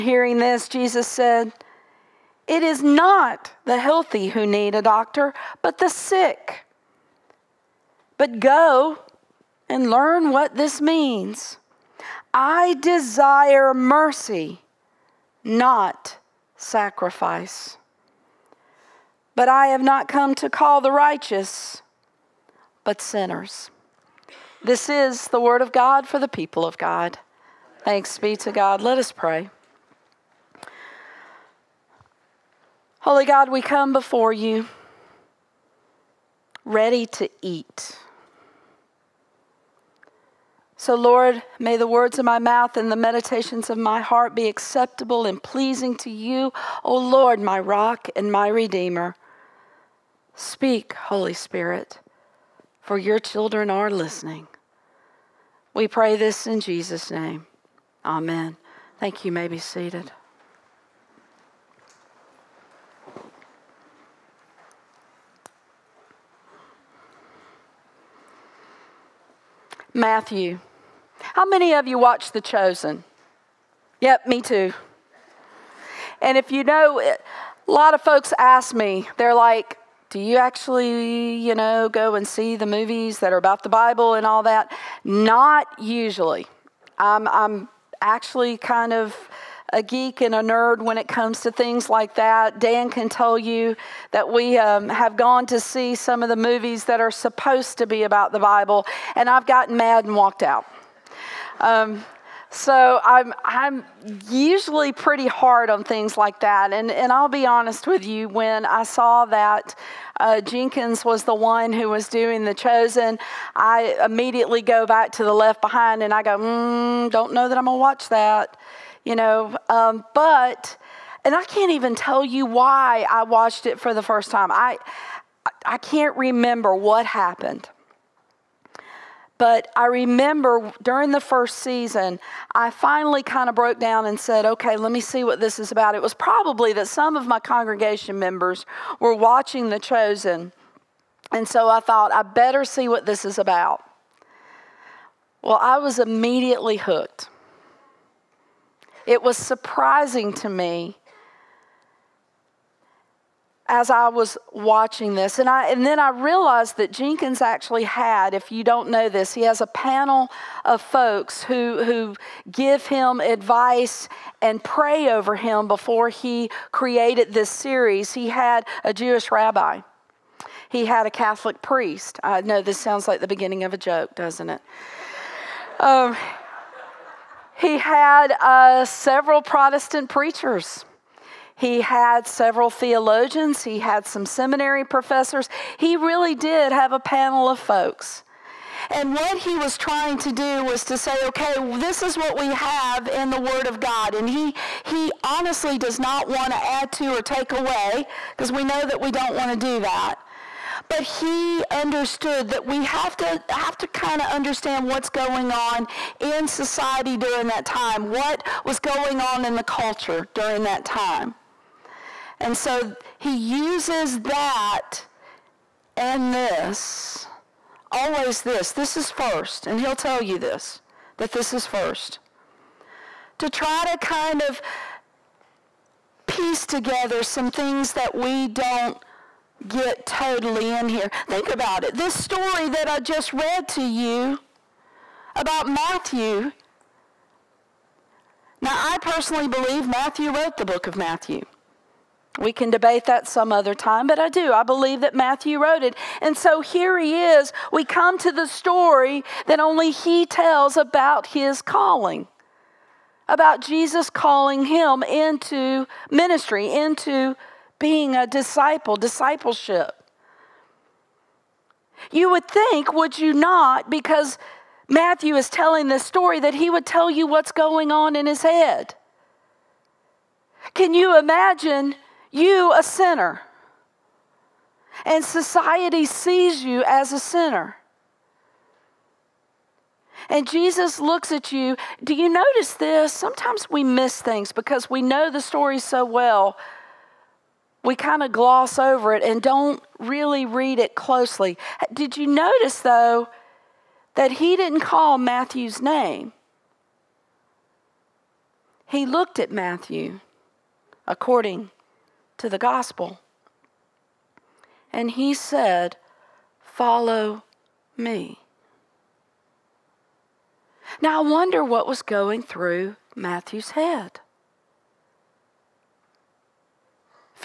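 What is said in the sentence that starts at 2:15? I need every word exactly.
It was probably that some of my congregation members were watching The Chosen.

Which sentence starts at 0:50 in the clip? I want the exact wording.
Speak, Holy Spirit, for your children are listening.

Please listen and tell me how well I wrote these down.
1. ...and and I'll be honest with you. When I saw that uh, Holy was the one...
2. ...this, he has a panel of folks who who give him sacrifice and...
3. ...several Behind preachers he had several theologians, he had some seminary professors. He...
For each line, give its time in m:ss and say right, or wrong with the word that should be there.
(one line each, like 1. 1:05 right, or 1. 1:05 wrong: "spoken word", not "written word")
1. 1:46 wrong: "Jenkins", not "Holy"
2. 2:39 wrong: "advice", not "sacrifice"
3. 2:58 wrong: "Protestant", not "Behind".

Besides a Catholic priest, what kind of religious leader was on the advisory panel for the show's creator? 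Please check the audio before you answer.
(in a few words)
Jewish rabbi.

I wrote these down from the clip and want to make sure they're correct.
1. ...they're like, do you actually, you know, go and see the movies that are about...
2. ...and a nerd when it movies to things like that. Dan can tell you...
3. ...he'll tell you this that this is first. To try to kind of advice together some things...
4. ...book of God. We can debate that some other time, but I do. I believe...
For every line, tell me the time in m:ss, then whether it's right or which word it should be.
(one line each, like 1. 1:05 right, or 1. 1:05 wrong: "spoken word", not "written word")
1. 1:19 right
2. 1:30 wrong: "comes", not "movies"
3. 3:39 wrong: "piece", not "advice"
4. 4:00 wrong: "Matthew", not "God".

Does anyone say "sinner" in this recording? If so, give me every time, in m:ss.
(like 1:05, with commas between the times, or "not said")
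0:23, 4:32, 4:37.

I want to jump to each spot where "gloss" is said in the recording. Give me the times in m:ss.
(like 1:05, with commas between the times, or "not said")
4:48.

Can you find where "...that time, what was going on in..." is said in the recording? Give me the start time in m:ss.
3:27.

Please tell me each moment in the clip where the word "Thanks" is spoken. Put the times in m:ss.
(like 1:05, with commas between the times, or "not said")
0:27, 0:59.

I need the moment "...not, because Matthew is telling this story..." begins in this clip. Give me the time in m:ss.
4:23.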